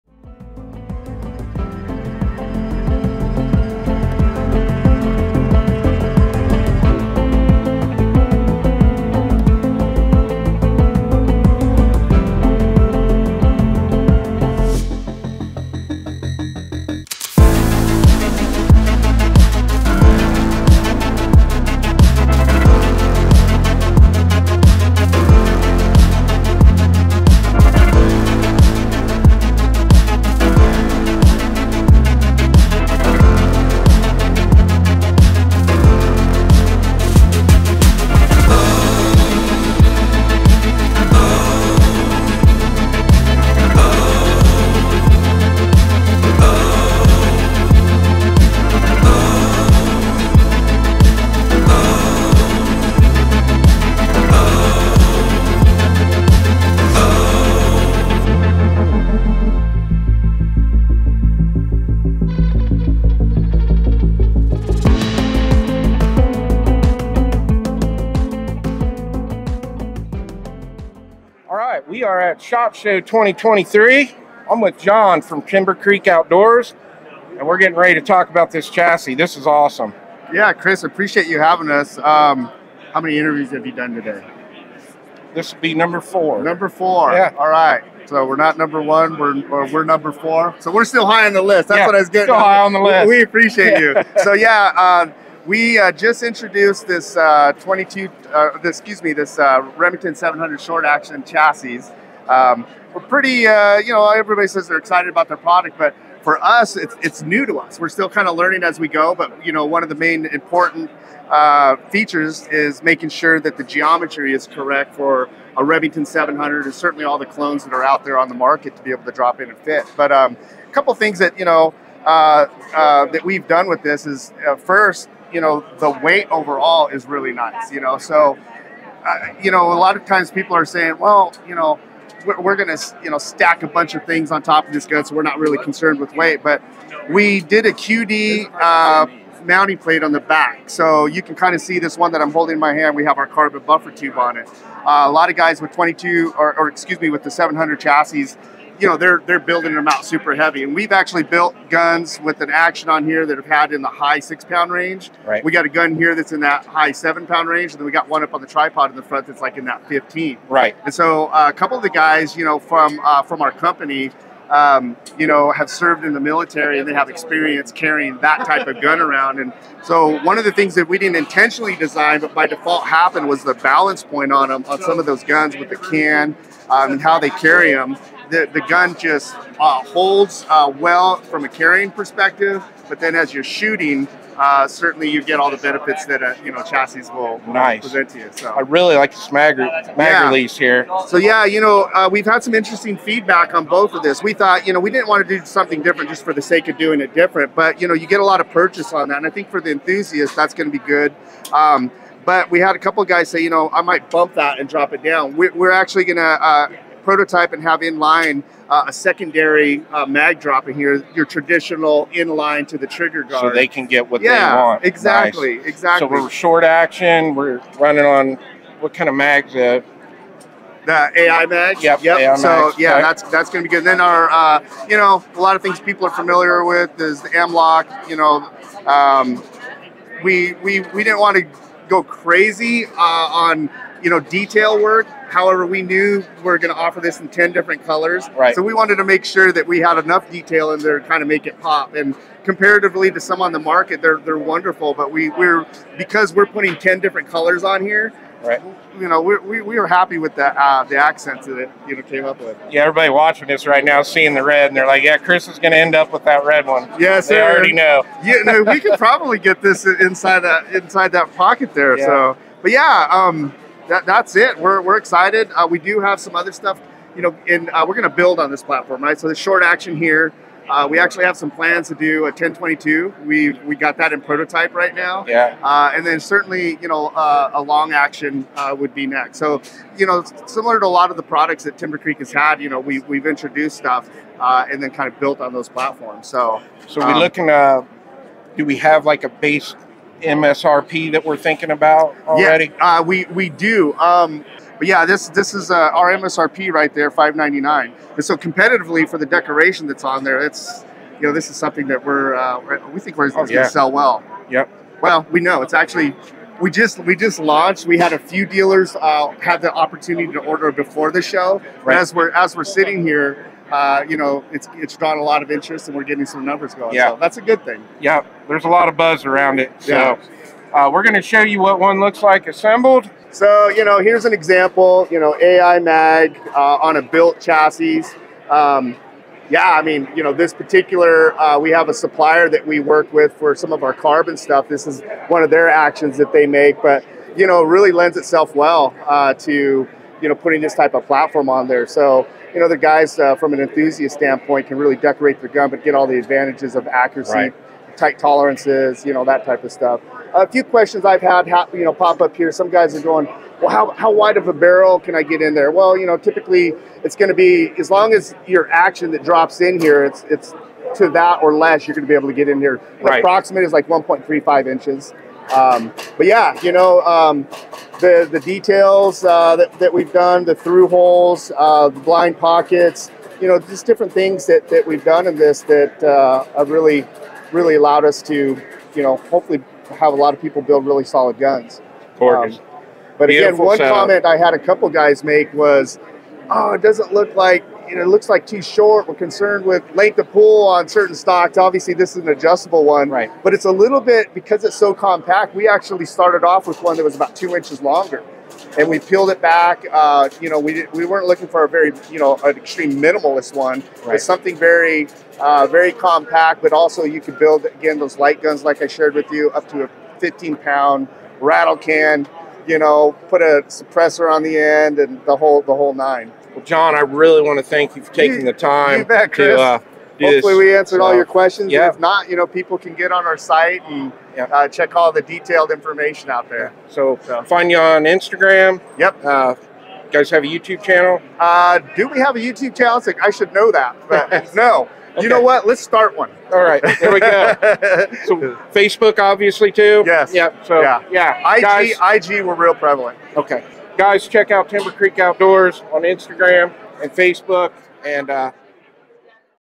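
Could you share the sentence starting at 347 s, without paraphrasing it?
tight tolerances, you know, that type of stuff.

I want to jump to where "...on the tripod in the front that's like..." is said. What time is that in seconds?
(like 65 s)
158 s.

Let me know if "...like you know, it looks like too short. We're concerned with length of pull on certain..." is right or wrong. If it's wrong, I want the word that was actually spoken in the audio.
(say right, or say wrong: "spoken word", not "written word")
right.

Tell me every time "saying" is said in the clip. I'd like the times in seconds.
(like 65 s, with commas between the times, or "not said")
130 s.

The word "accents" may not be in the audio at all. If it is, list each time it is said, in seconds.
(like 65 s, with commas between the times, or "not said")
250 s.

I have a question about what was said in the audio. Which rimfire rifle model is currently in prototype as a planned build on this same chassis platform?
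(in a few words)
1022.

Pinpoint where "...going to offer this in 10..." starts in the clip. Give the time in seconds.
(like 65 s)
236 s.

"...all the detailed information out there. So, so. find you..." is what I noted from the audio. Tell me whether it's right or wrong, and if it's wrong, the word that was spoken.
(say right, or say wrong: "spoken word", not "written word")
right.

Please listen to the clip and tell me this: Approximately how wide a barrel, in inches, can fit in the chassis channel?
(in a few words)
1.35 inches.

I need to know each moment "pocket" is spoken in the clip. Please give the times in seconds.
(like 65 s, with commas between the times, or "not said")
261 s, 372 s.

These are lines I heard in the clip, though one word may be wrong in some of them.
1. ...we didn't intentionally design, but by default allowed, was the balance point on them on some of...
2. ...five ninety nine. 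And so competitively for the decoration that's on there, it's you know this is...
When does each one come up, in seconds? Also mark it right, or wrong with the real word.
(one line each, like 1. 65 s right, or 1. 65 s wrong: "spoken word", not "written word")
1. 170 s wrong: "happened", not "allowed"
2. 297 s right.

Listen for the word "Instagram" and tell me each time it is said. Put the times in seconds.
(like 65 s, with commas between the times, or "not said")
428 s, 446 s.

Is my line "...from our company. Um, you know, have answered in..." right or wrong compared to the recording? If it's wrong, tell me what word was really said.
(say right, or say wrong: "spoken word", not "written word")
wrong: "served", not "answered".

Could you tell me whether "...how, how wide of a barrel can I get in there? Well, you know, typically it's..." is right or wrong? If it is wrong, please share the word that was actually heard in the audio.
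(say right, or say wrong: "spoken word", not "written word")
right.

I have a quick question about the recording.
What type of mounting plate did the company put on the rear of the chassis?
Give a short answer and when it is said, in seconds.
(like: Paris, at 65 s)
QD, at 137 s.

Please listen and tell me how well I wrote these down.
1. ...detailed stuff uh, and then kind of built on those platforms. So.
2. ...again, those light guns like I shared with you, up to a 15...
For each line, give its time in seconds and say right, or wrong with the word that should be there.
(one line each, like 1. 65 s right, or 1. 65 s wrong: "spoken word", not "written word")
1. 283 s wrong: "introduced", not "detailed"
2. 407 s right.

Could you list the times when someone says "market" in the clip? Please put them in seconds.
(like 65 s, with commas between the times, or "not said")
118 s, 243 s.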